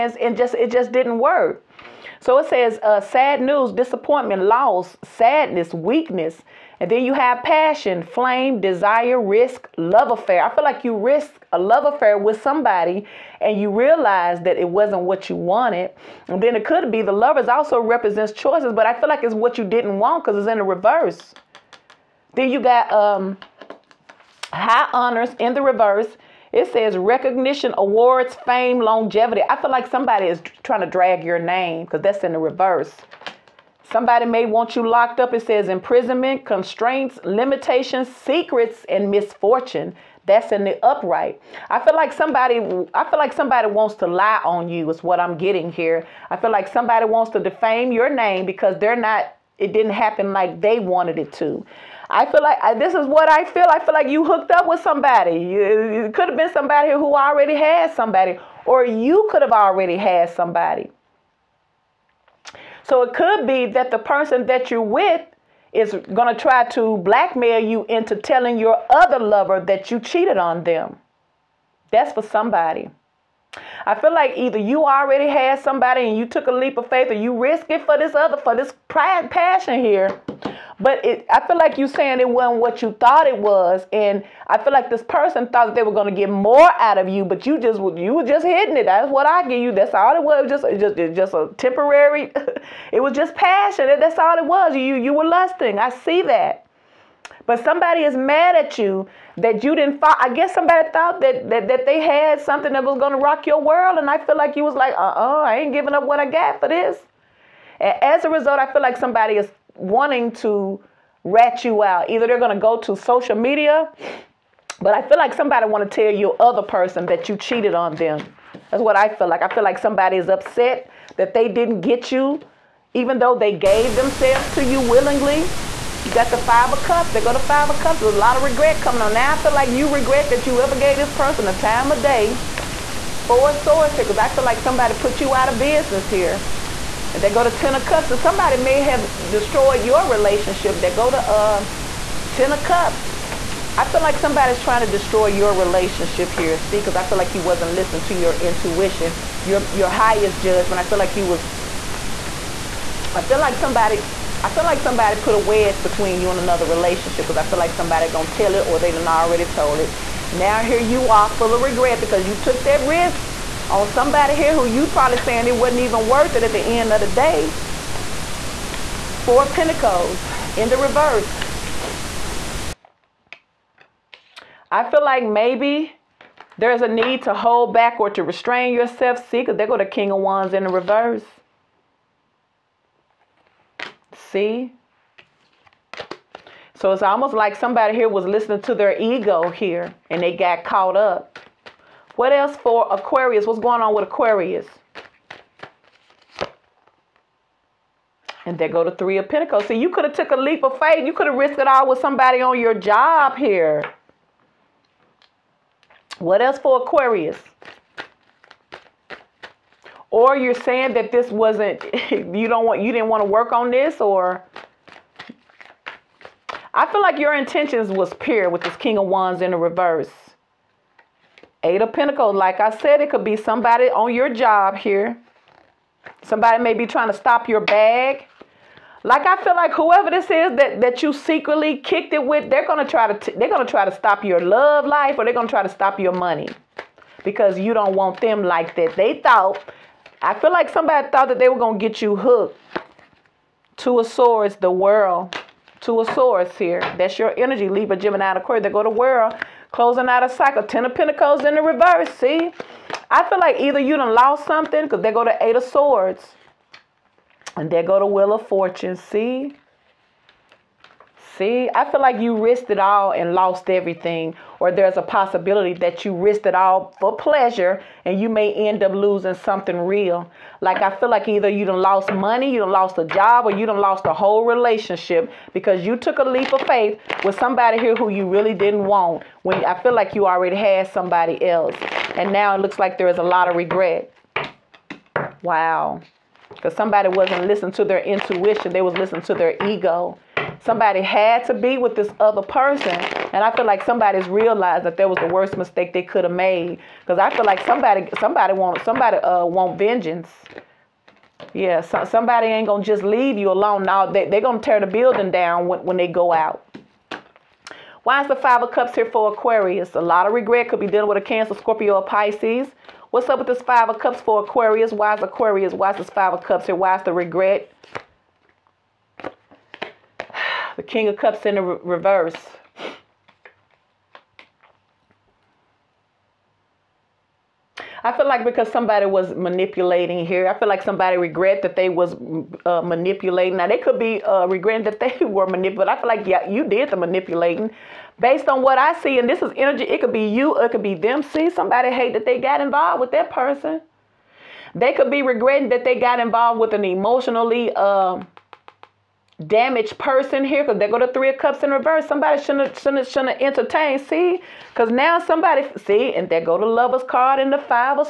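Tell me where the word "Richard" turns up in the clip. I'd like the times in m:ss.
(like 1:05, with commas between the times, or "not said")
not said.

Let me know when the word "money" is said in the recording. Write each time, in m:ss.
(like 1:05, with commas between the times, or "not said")
3:56, 4:32.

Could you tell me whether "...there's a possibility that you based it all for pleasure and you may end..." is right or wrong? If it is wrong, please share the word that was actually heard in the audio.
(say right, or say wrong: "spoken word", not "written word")
wrong: "risked", not "based".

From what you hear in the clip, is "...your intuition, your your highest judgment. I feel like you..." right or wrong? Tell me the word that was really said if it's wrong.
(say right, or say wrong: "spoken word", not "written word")
right.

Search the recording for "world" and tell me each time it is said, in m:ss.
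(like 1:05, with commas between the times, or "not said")
1:43, 4:04, 4:08.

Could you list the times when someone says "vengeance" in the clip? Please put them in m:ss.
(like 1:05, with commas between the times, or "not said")
4:59.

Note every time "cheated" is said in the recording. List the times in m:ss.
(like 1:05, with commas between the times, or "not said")
1:09, 1:57.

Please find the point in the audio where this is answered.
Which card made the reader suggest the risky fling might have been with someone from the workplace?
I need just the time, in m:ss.
3:18.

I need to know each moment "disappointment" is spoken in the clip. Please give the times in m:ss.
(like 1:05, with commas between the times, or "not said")
0:03.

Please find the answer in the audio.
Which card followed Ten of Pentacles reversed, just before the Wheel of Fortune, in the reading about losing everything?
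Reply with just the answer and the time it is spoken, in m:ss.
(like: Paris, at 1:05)
Eight of Swords, at 4:15.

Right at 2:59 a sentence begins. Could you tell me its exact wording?
See, because they go to King of Wands in the reverse.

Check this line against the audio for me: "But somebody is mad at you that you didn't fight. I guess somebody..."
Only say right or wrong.
right.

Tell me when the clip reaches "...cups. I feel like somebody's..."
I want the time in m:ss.
2:22.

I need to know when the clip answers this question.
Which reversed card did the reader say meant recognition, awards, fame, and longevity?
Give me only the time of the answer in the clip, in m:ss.
0:24.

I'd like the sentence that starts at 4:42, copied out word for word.
And now it looks like there is a lot of regret.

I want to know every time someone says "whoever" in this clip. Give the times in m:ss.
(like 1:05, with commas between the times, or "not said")
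3:49.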